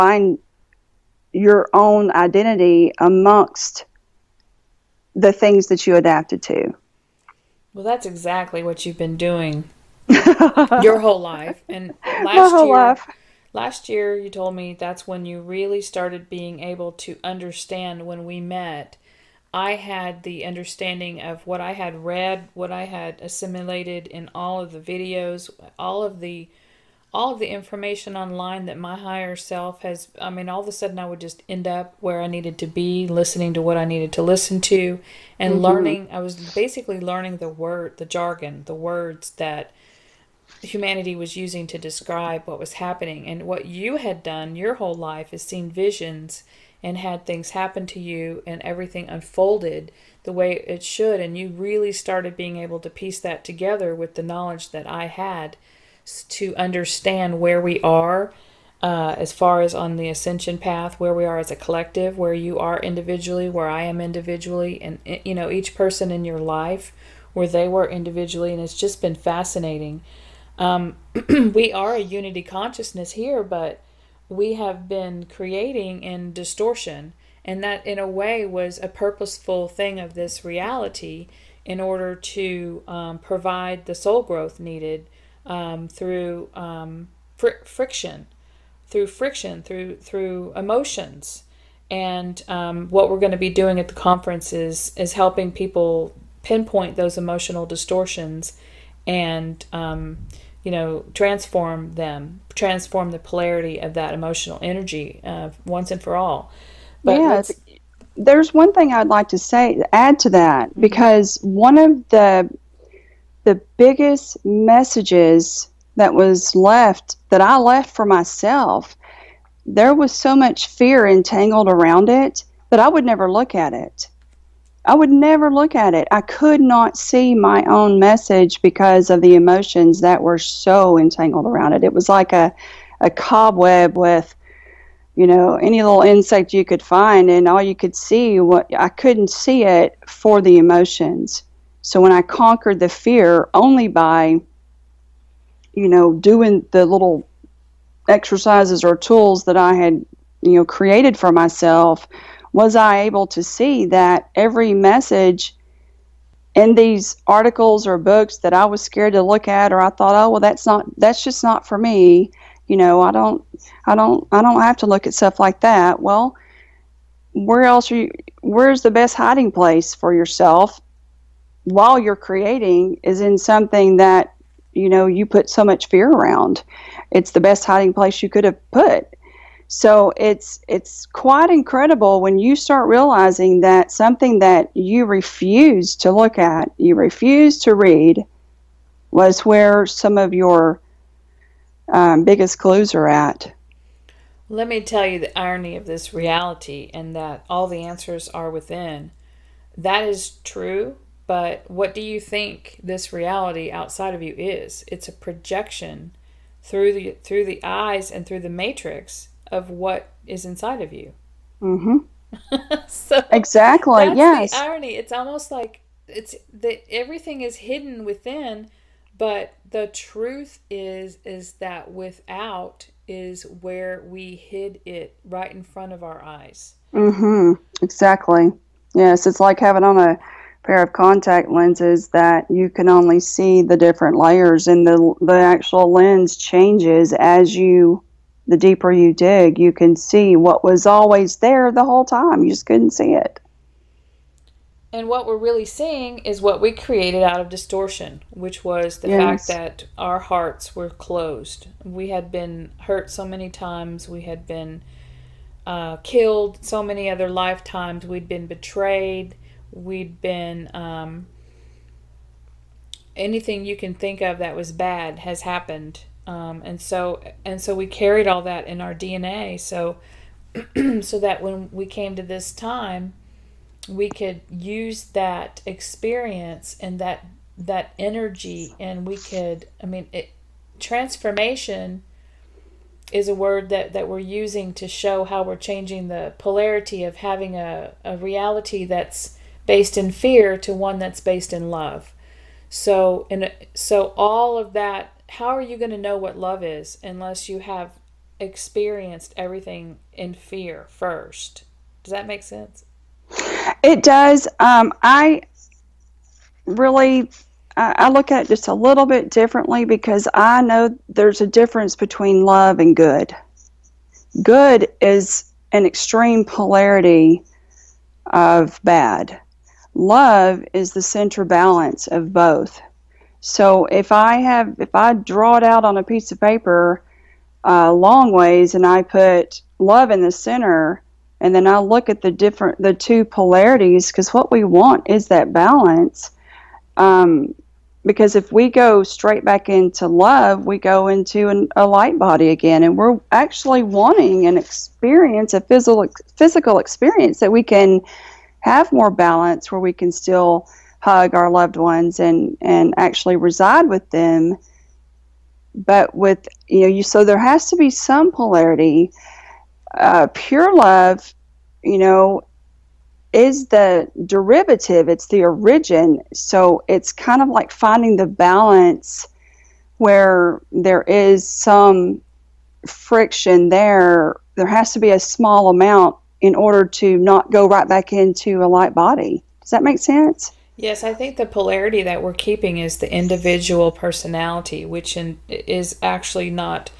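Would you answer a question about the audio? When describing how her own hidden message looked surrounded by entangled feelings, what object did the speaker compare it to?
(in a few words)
a cobweb.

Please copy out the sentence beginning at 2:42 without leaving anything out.
You know, I don't I don't I don't have to look at stuff like that.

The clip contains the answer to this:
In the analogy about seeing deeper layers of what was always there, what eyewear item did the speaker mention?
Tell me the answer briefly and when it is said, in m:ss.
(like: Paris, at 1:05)
contact lenses, at 3:50.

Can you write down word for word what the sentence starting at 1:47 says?
But yeah, there's one thing I'd like to say add to that mm-hmm.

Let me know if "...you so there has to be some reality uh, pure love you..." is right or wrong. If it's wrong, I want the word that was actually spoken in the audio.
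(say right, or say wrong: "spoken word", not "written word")
wrong: "polarity", not "reality".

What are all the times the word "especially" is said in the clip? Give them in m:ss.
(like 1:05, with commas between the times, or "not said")
not said.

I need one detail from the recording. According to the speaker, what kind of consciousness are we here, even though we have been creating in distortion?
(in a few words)
unity consciousness.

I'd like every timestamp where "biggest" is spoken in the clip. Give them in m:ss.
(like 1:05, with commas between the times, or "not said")
1:53, 3:12.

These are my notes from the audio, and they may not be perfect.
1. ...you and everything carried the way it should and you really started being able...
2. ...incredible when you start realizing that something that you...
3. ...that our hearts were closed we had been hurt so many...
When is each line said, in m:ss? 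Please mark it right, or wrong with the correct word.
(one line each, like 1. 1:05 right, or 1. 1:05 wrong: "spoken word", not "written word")
1. 0:47 wrong: "unfolded", not "carried"
2. 3:01 right
3. 4:09 right.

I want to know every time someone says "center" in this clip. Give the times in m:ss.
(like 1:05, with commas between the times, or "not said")
5:21, 5:30.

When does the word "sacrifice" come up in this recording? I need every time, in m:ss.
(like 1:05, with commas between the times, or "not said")
not said.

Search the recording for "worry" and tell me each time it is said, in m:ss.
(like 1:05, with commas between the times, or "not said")
not said.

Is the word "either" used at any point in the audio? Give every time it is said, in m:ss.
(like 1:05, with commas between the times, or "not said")
not said.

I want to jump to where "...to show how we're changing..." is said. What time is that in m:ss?
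4:44.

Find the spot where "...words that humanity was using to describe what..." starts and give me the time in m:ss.
0:38.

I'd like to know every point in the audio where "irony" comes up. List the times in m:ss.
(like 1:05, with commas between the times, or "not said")
3:15, 3:34.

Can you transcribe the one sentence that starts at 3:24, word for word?
It's a projection through the through the eyes and through the matrix of what is inside of you.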